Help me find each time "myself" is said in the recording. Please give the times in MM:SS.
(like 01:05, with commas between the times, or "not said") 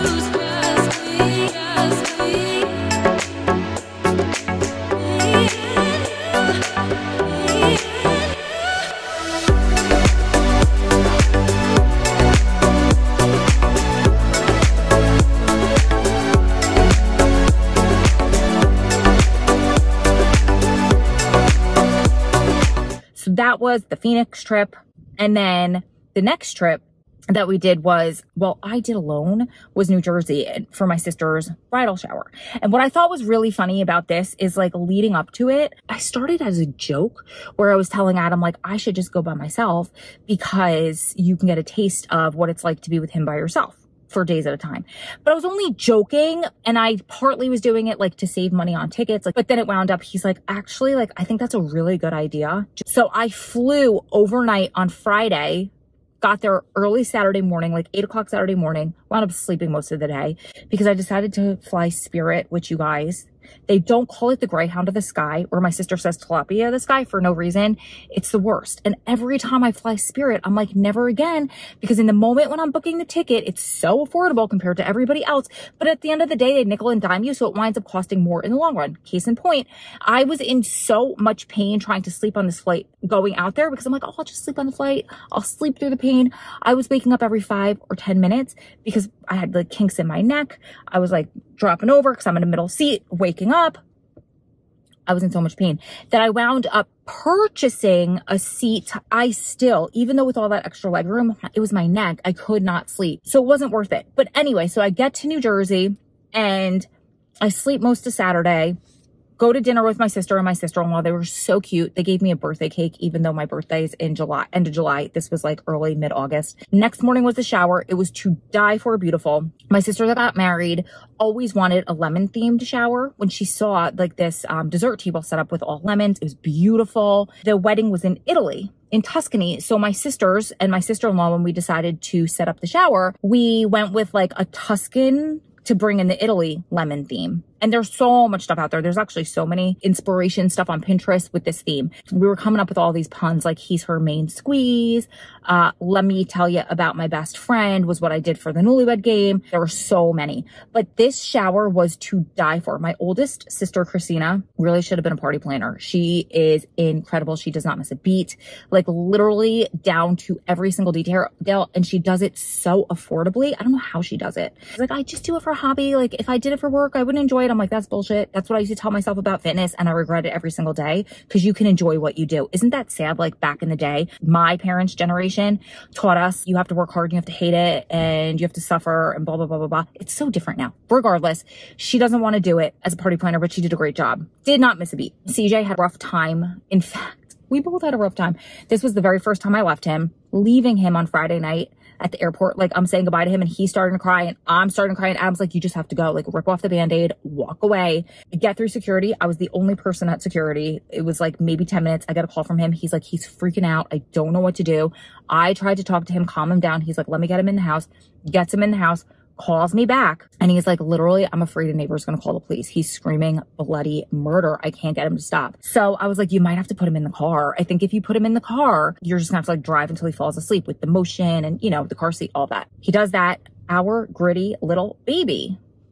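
00:39, 02:48.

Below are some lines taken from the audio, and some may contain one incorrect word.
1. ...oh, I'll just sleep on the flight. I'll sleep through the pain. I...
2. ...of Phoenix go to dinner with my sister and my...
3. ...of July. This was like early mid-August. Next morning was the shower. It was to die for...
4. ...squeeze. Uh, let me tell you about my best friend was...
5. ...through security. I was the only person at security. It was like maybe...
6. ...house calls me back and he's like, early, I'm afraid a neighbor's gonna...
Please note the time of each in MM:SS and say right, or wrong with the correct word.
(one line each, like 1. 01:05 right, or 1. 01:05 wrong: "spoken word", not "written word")
1. 01:24 right
2. 01:48 wrong: "Saturday", not "Phoenix"
3. 01:54 right
4. 02:24 right
5. 03:18 right
6. 03:28 wrong: "literally", not "early".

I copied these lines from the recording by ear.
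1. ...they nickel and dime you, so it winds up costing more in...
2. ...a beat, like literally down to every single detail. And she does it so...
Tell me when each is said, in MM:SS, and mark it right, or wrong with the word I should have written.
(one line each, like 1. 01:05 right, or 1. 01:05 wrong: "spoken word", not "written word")
1. 01:16 right
2. 02:37 right.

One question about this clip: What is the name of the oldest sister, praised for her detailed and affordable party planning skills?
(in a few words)
Christina.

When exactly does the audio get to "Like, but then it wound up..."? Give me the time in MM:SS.
00:49.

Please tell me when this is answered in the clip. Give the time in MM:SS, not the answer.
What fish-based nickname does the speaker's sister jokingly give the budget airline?
01:06.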